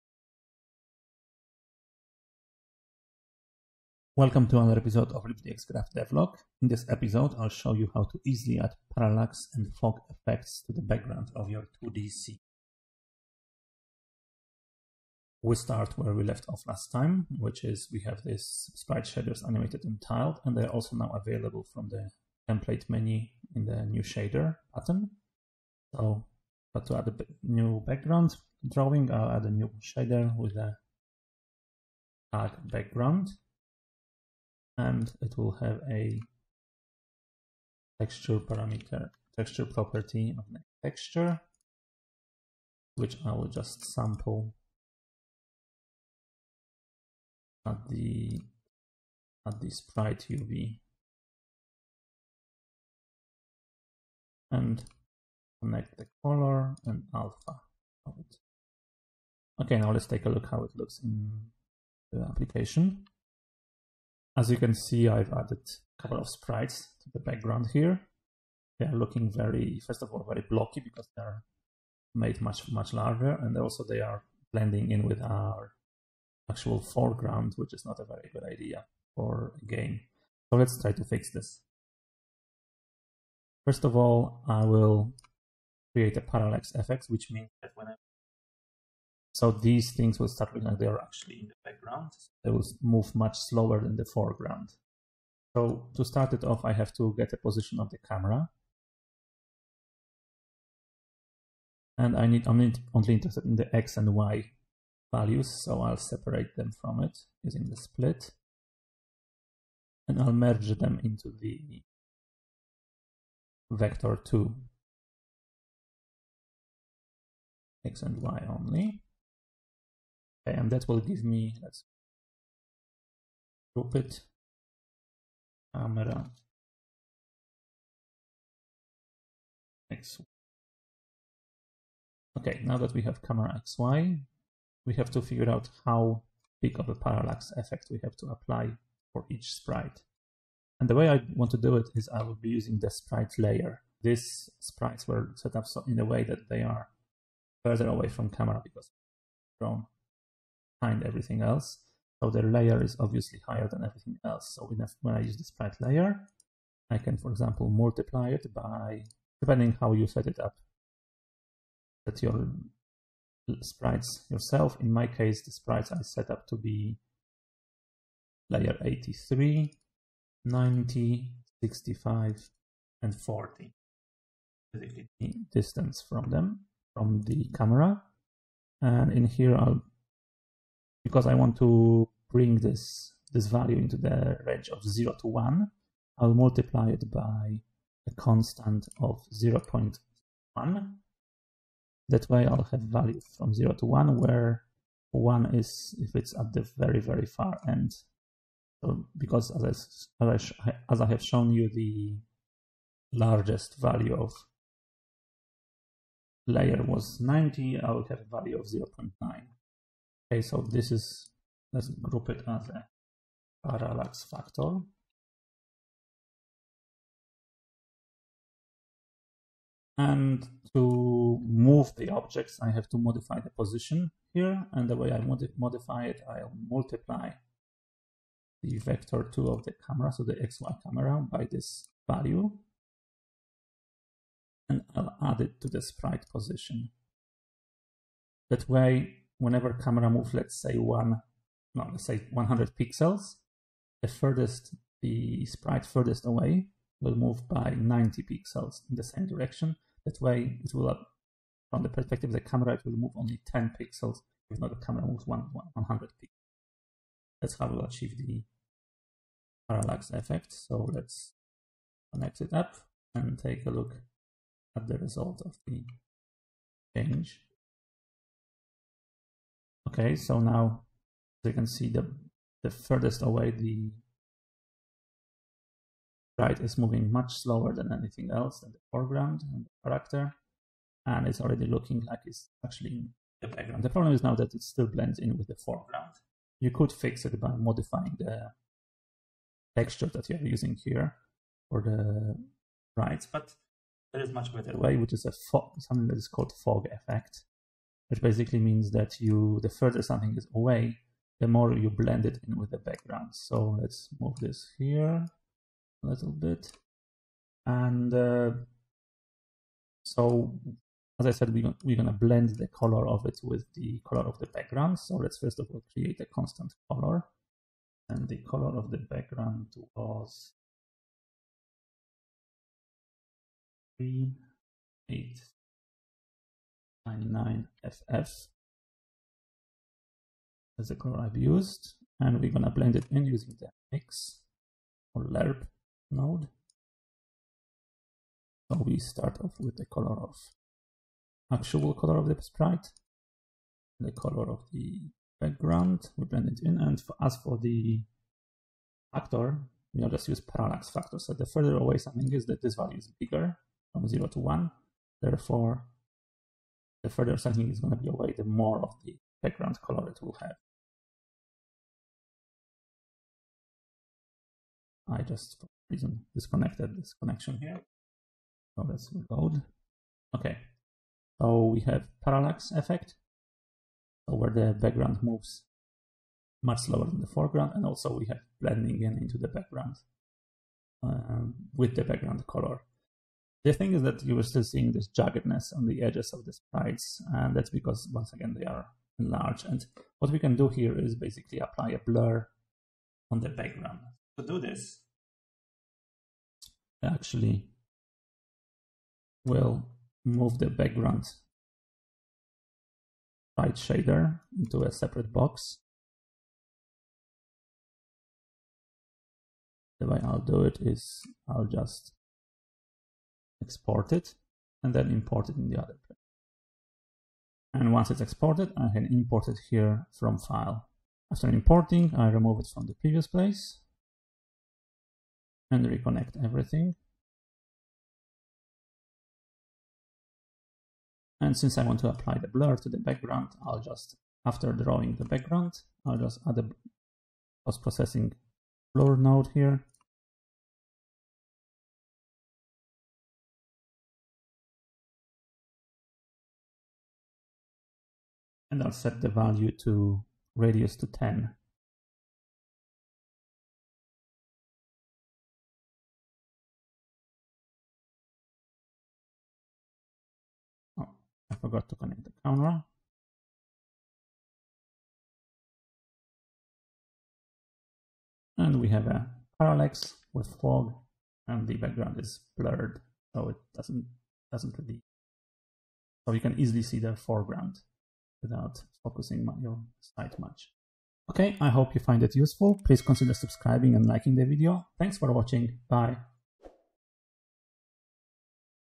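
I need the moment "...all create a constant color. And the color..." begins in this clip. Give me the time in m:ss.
5:15.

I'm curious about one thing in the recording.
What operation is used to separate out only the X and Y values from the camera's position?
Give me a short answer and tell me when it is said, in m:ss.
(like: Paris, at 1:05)
split, at 1:47.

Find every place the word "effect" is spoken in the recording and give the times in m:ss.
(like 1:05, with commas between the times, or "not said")
0:10, 1:26, 2:17, 4:20, 4:56, 6:12.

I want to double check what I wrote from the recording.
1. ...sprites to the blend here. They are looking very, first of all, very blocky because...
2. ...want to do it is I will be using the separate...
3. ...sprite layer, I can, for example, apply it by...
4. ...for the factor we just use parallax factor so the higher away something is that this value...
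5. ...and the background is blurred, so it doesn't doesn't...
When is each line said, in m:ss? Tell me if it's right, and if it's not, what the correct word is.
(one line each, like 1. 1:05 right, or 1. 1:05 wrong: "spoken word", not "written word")
1. 1:06 wrong: "background", not "blend"
2. 2:21 wrong: "sprite", not "separate"
3. 2:35 wrong: "multiply", not "apply"
4. 5:47 wrong: "further", not "higher"
5. 7:51 right.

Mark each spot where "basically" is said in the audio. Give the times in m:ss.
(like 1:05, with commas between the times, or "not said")
2:54, 4:58, 6:31.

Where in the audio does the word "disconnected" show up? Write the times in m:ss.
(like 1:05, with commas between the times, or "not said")
6:06.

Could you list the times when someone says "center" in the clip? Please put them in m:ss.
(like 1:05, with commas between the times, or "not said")
not said.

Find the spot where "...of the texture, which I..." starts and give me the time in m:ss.
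0:40.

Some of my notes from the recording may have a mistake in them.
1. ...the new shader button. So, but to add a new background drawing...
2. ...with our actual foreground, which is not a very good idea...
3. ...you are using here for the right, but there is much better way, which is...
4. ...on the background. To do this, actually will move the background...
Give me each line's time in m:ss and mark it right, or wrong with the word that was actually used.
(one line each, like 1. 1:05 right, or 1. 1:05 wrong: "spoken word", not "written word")
1. 0:23 right
2. 1:15 right
3. 4:50 right
4. 6:33 right.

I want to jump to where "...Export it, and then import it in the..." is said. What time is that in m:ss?
6:53.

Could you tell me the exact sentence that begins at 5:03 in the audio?
So let's move this here a little bit.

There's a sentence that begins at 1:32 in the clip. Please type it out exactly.
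They will move much slower than the foreground.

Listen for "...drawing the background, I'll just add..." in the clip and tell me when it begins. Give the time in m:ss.
7:14.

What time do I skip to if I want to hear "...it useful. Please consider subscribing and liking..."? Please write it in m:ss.
8:02.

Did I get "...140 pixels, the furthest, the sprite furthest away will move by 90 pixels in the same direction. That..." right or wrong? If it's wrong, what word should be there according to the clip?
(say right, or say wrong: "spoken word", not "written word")
wrong: "100", not "140".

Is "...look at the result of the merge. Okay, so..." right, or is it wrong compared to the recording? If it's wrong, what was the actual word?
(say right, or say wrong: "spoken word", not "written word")
wrong: "change", not "merge".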